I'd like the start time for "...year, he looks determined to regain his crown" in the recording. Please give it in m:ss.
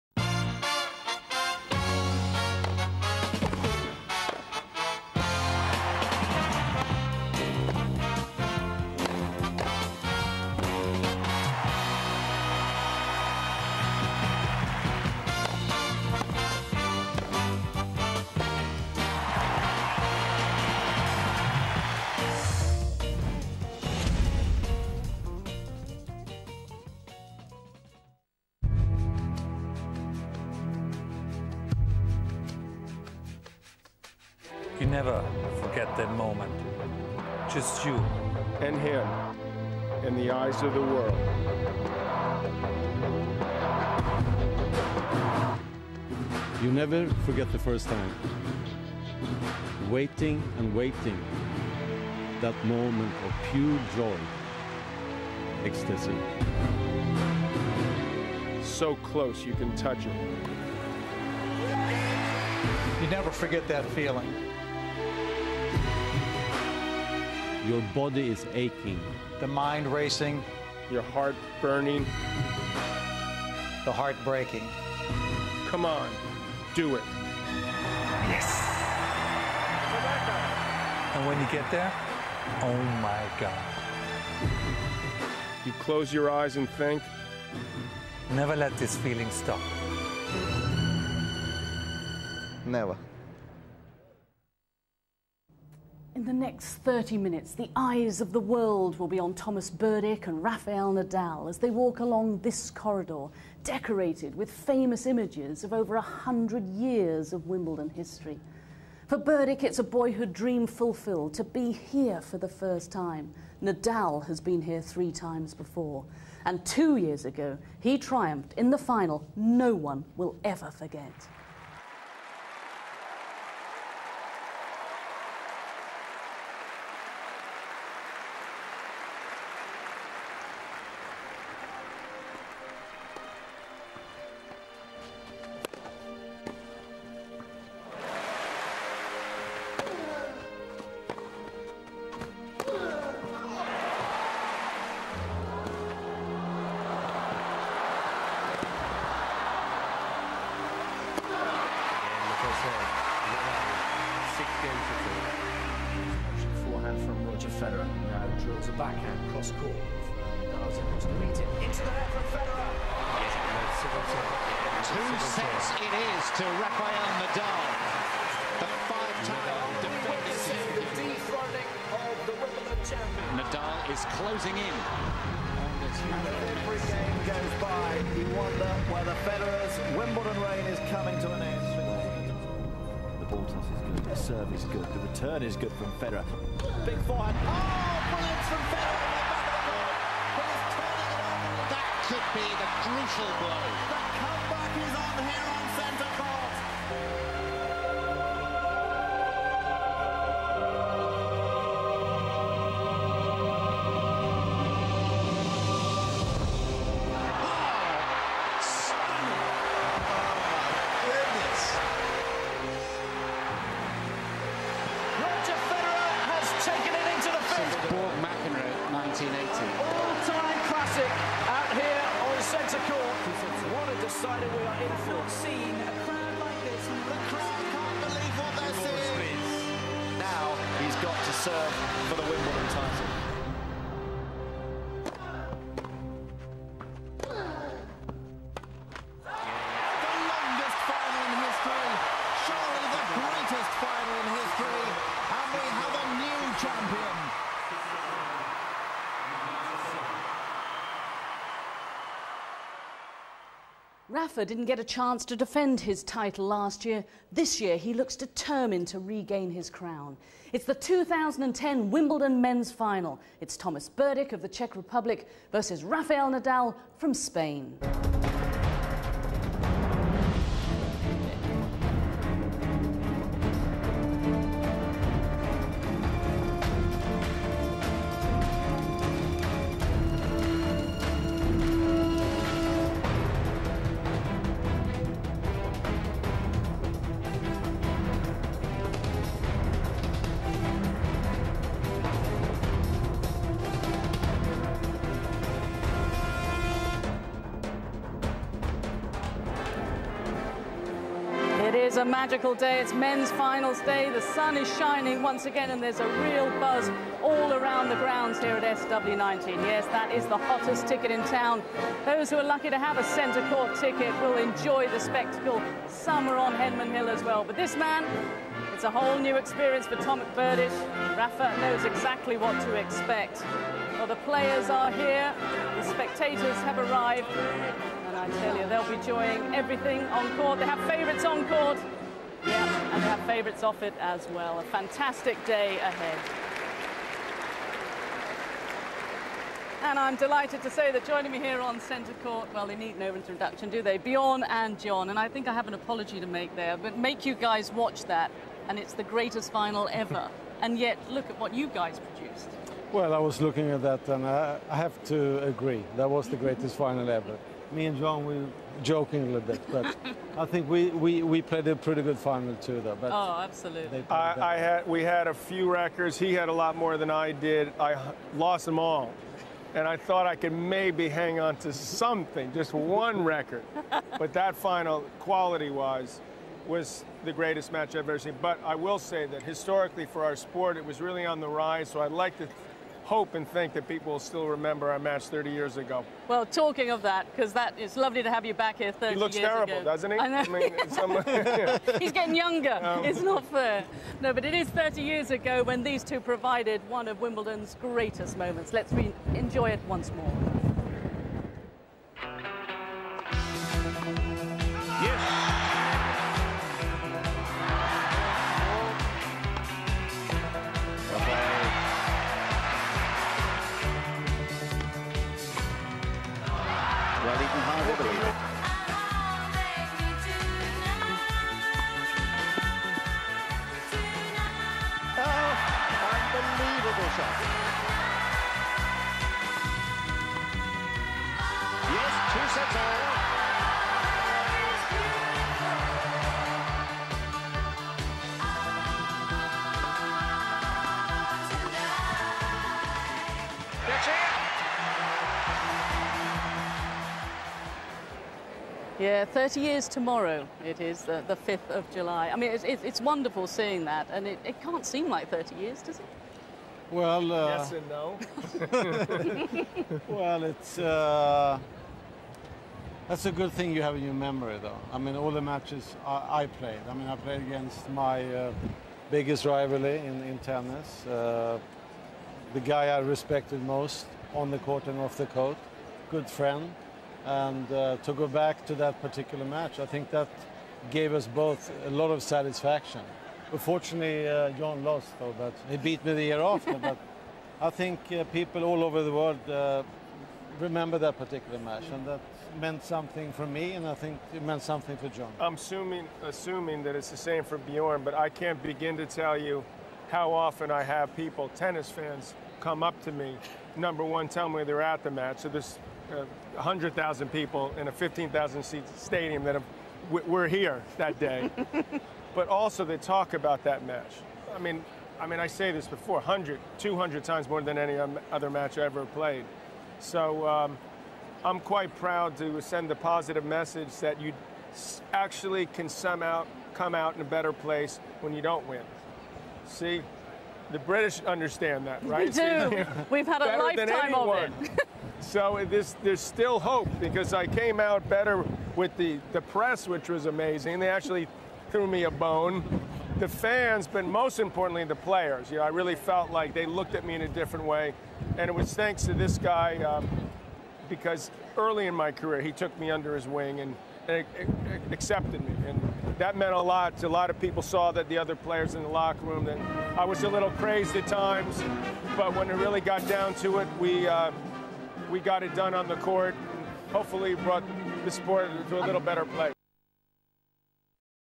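4:17.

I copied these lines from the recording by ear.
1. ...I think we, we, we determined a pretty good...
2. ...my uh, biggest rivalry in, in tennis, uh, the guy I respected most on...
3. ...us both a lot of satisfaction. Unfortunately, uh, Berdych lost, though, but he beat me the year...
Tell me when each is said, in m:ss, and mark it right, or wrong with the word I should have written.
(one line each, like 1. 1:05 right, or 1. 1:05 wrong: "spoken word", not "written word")
1. 6:00 wrong: "played", not "determined"
2. 7:47 right
3. 8:01 wrong: "John", not "Berdych".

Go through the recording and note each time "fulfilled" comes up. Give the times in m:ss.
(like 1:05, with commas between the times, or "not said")
1:50.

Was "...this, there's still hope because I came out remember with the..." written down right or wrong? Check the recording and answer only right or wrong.
wrong.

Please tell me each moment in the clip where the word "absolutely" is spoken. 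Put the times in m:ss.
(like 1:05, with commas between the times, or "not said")
6:03.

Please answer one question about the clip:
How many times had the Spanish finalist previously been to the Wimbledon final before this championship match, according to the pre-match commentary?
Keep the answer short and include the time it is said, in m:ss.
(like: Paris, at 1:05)
3, at 1:54.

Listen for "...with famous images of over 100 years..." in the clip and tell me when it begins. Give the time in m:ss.
1:44.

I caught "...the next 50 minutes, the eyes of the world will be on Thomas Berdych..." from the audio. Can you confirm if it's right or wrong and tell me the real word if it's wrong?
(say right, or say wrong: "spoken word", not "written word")
wrong: "30", not "50".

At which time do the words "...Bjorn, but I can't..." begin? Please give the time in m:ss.
8:17.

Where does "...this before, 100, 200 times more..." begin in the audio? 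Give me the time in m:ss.
8:35.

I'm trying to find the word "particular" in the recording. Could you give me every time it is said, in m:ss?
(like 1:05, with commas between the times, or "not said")
7:59, 8:11.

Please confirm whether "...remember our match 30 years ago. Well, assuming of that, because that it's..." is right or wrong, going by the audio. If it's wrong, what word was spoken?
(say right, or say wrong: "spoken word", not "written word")
wrong: "talking", not "assuming".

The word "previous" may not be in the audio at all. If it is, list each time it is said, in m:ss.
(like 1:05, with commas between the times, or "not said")
not said.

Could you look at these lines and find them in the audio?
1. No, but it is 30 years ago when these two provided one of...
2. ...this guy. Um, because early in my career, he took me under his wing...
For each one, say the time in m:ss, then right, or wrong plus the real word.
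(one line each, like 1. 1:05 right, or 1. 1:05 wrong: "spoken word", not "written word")
1. 6:34 right
2. 9:09 right.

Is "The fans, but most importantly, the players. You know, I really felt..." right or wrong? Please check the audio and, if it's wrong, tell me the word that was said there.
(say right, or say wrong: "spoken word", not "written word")
right.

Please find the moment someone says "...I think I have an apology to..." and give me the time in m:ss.
5:45.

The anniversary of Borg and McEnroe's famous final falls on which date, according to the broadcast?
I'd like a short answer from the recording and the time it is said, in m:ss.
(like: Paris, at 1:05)
5 July, at 7:31.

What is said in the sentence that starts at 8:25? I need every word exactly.
So there's uh, 100,000 people in a 15,000 seat stadium that have, we're here that day.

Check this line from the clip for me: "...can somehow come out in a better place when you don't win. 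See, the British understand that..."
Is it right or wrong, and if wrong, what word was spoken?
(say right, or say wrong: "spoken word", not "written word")
right.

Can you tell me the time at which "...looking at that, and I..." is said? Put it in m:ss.
5:53.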